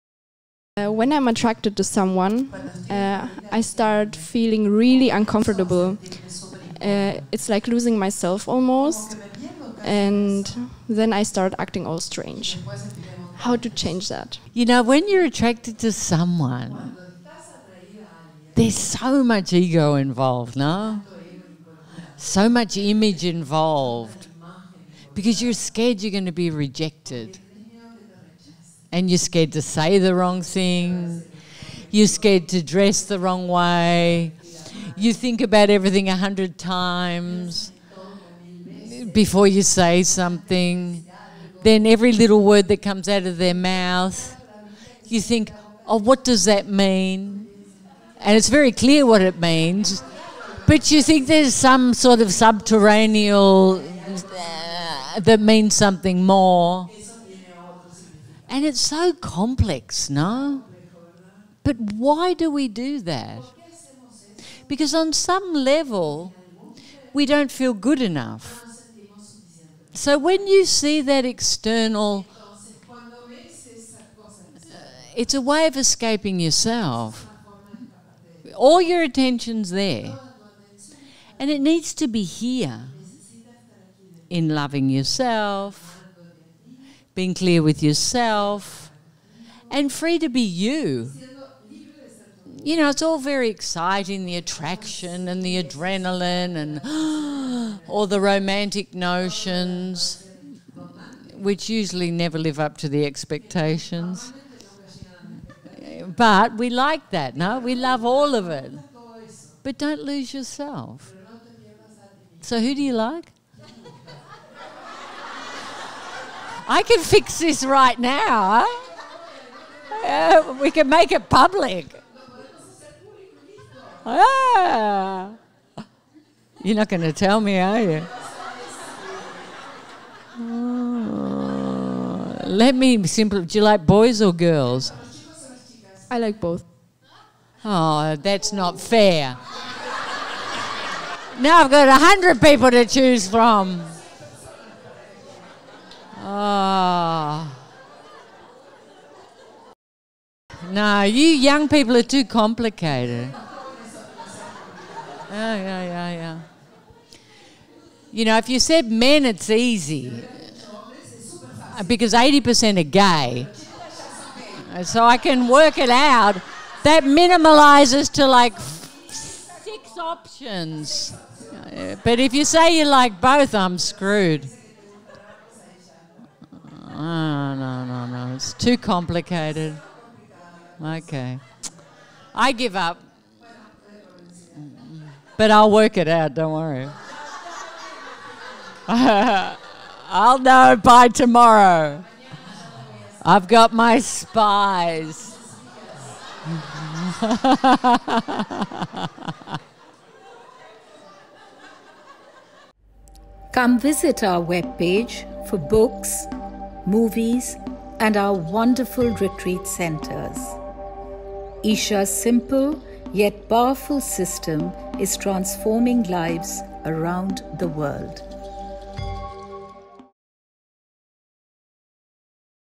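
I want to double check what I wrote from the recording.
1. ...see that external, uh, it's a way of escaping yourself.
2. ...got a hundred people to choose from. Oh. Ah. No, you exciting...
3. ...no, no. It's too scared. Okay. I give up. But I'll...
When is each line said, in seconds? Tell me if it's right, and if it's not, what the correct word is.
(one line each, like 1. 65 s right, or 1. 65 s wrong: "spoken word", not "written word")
1. 70 s right
2. 141 s wrong: "young", not "exciting"
3. 177 s wrong: "complicated", not "scared".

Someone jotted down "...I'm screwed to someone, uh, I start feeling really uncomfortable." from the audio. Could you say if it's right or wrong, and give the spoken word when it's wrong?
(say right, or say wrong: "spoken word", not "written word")
wrong: "attracted", not "screwed".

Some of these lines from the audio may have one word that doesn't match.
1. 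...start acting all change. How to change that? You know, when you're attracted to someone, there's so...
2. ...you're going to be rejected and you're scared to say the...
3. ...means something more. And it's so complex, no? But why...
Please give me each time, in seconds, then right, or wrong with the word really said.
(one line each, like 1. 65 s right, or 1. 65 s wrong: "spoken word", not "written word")
1. 11 s wrong: "strange", not "change"
2. 26 s right
3. 55 s right.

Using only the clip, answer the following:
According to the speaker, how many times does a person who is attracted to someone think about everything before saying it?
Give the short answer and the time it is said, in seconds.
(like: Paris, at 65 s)
100, at 36 s.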